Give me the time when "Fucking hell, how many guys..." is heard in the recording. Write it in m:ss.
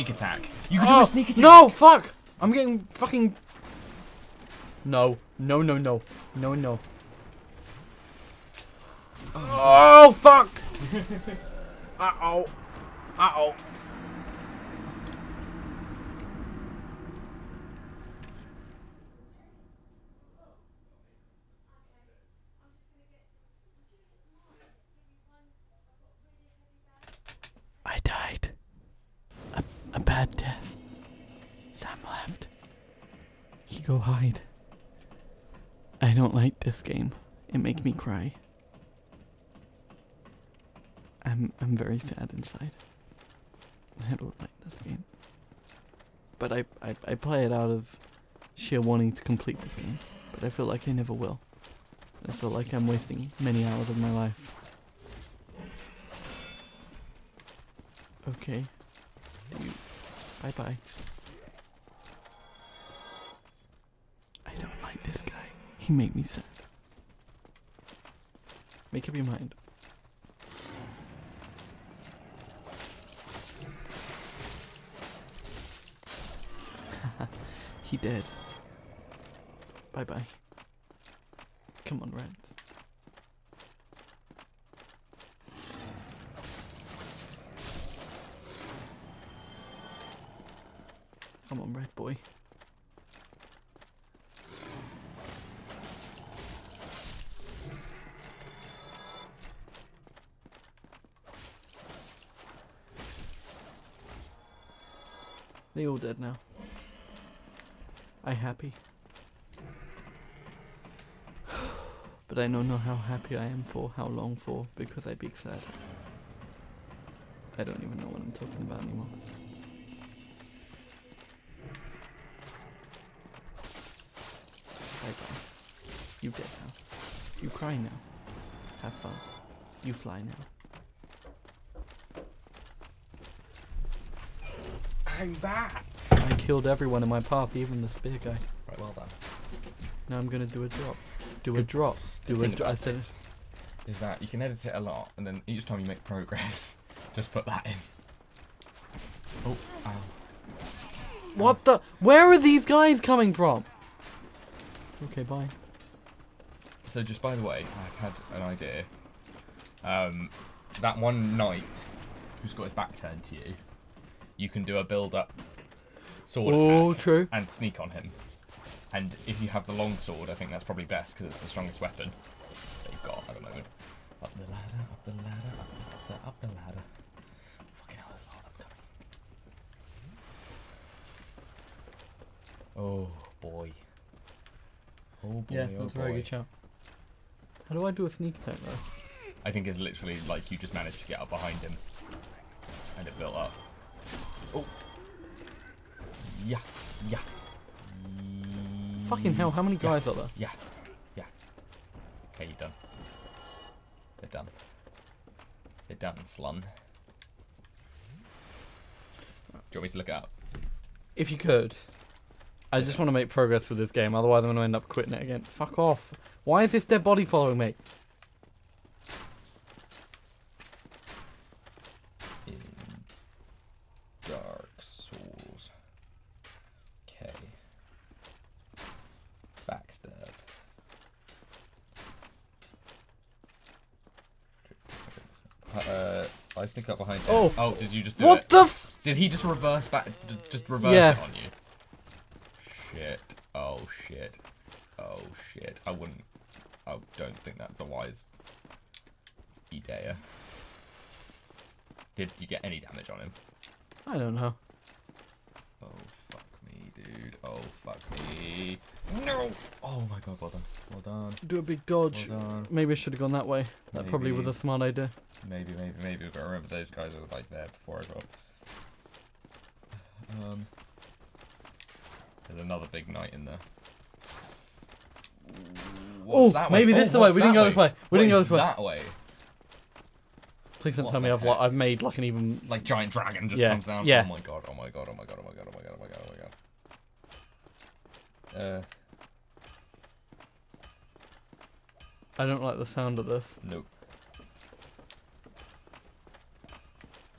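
3:19.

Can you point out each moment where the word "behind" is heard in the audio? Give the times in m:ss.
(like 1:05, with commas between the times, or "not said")
3:11, 3:56.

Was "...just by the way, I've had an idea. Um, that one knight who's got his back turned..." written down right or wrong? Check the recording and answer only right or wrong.
right.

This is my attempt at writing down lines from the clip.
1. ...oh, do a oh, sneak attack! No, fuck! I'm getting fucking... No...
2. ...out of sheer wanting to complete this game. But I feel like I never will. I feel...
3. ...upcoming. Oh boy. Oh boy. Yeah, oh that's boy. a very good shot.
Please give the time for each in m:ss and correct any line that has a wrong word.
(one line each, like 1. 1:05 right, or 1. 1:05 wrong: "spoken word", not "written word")
1. 0:00 right
2. 0:47 right
3. 2:58 right.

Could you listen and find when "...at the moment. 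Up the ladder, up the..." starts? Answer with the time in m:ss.
2:53.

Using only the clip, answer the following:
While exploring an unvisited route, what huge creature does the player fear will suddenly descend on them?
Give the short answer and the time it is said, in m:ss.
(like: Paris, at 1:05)
Giant dragon, at 4:42.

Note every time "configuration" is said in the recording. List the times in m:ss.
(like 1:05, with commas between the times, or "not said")
not said.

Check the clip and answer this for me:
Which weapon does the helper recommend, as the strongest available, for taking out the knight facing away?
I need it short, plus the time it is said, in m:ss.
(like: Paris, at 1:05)
Long sword, at 2:49.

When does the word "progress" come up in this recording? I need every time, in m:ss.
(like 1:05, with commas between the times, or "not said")
2:26, 3:33.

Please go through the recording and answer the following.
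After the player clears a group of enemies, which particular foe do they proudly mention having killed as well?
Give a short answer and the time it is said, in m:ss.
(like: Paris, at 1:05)
The spear guy, at 2:17.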